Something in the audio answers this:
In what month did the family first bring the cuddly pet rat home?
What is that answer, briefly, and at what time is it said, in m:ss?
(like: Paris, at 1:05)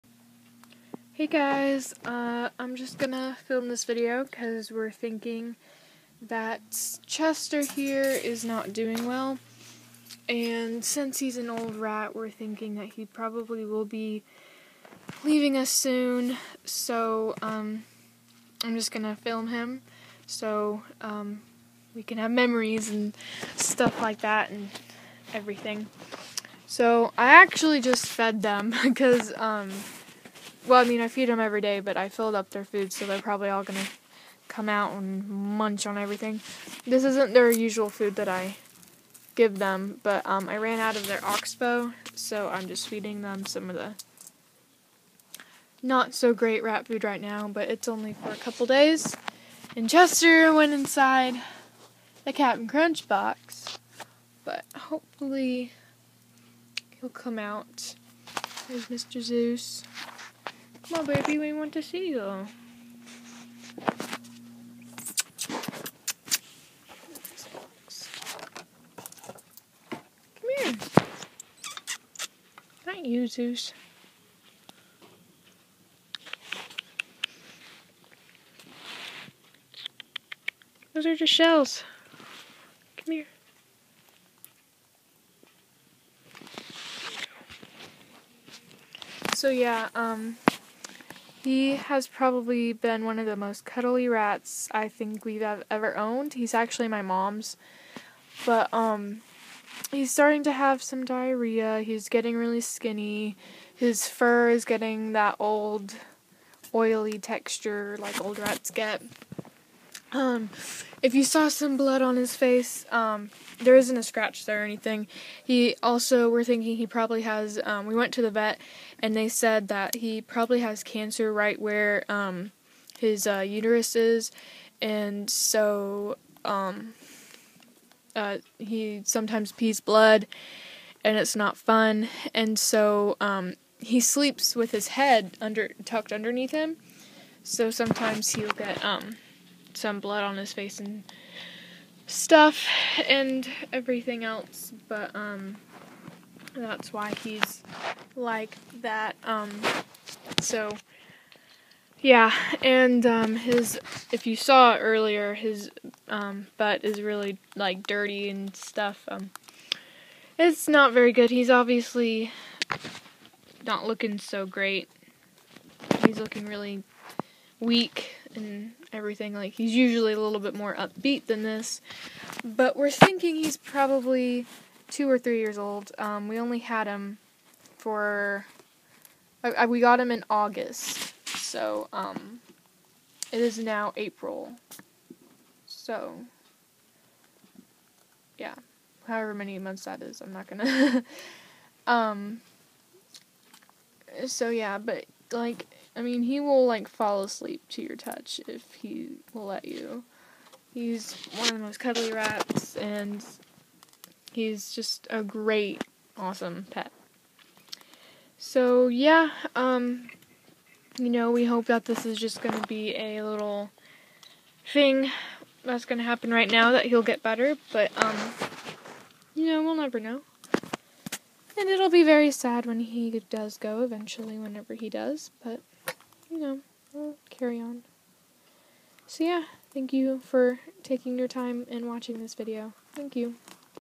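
August, at 3:00.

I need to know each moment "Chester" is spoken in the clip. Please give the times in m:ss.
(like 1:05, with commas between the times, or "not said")
0:07, 0:49.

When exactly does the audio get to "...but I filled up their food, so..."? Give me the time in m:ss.
0:31.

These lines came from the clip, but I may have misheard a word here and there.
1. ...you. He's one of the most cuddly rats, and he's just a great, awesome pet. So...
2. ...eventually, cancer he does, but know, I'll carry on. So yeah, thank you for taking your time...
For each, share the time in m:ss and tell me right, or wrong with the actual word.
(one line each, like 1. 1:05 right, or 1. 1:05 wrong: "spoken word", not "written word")
1. 3:19 right
2. 3:43 wrong: "whenever", not "cancer".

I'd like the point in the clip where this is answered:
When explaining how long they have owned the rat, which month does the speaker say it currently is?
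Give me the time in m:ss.
3:03.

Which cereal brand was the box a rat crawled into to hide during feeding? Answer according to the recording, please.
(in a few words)
Captain Crunch.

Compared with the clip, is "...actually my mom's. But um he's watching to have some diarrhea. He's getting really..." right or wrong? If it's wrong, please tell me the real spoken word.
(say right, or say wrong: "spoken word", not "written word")
wrong: "starting", not "watching".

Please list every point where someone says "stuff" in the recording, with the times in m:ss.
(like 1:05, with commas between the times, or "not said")
0:23, 2:22, 2:38.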